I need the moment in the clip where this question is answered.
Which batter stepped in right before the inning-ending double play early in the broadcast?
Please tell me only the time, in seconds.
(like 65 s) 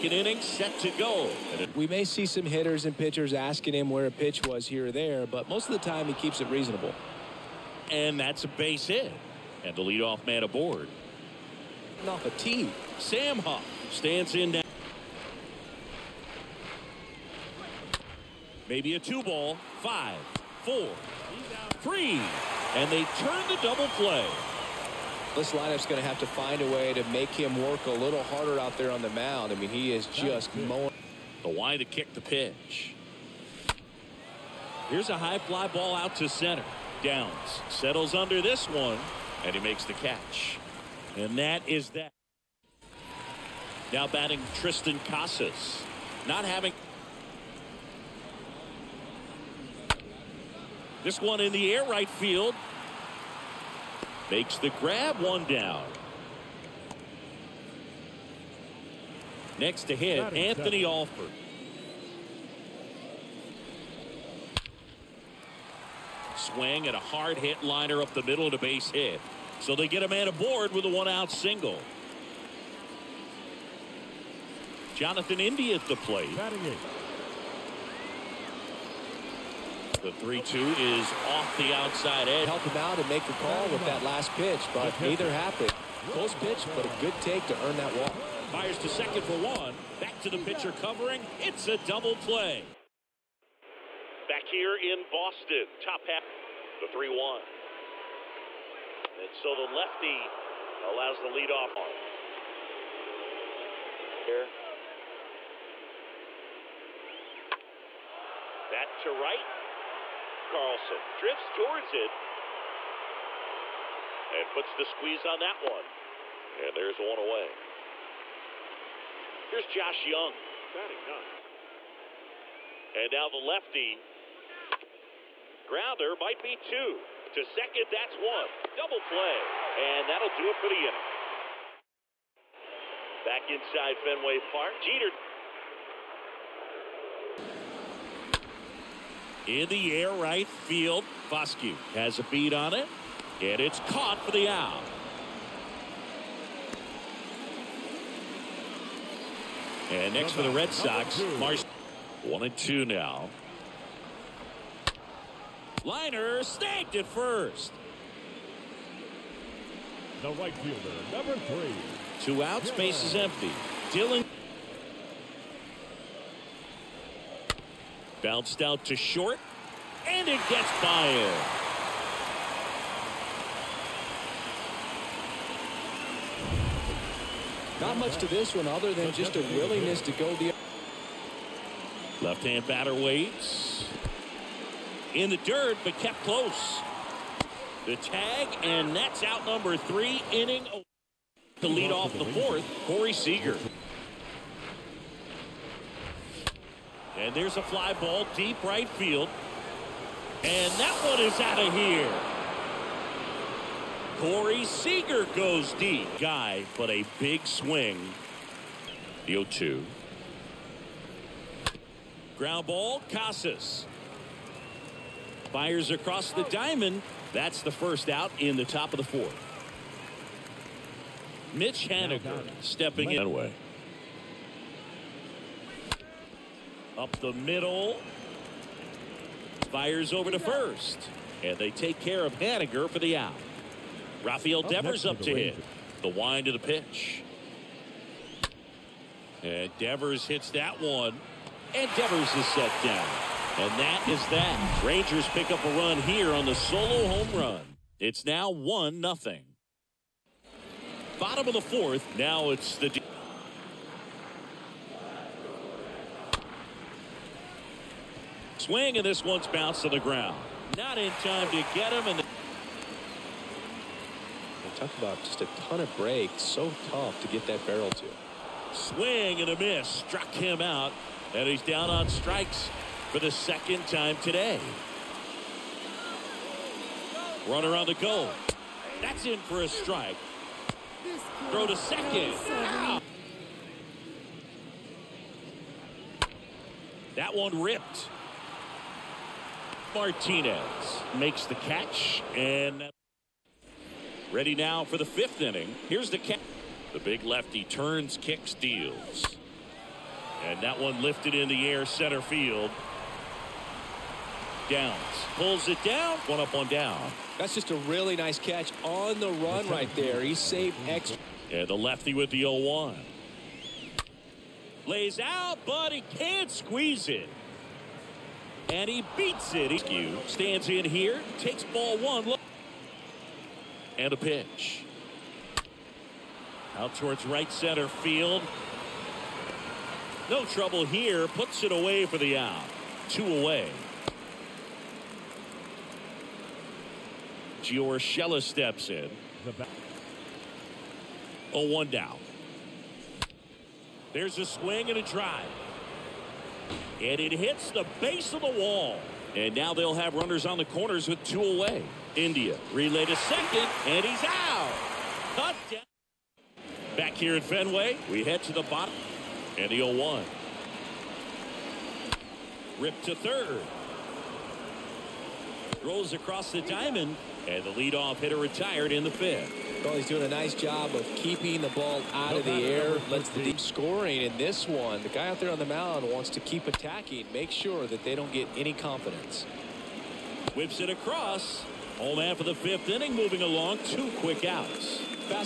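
12 s.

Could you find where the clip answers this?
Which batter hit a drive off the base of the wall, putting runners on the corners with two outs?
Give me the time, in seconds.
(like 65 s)
337 s.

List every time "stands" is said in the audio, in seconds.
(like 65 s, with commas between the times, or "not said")
13 s, 320 s.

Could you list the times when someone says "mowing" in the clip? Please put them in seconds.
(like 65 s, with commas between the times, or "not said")
30 s.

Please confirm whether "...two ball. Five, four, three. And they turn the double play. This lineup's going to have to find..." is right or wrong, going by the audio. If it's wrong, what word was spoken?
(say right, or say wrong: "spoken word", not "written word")
right.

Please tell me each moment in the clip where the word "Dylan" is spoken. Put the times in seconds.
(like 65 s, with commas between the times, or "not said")
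163 s.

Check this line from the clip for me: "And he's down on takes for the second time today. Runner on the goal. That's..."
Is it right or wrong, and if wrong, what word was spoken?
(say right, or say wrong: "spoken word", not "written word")
wrong: "strikes", not "takes".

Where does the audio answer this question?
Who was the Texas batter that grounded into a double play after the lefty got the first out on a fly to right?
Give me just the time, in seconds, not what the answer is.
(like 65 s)
119 s.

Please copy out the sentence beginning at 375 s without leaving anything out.
The guy out there on the mound wants to keep attacking.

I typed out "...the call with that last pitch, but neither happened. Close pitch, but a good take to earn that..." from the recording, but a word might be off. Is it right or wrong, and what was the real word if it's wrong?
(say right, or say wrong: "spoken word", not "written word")
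right.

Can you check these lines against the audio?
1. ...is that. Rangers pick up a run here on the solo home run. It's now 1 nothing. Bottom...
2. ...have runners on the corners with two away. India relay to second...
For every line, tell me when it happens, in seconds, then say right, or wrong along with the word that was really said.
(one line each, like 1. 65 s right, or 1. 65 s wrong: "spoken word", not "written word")
1. 244 s right
2. 349 s right.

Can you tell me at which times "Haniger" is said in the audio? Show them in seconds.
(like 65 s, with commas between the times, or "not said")
221 s, 232 s.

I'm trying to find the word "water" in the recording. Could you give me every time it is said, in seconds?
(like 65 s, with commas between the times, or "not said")
not said.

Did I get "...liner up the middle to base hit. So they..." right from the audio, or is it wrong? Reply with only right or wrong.
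right.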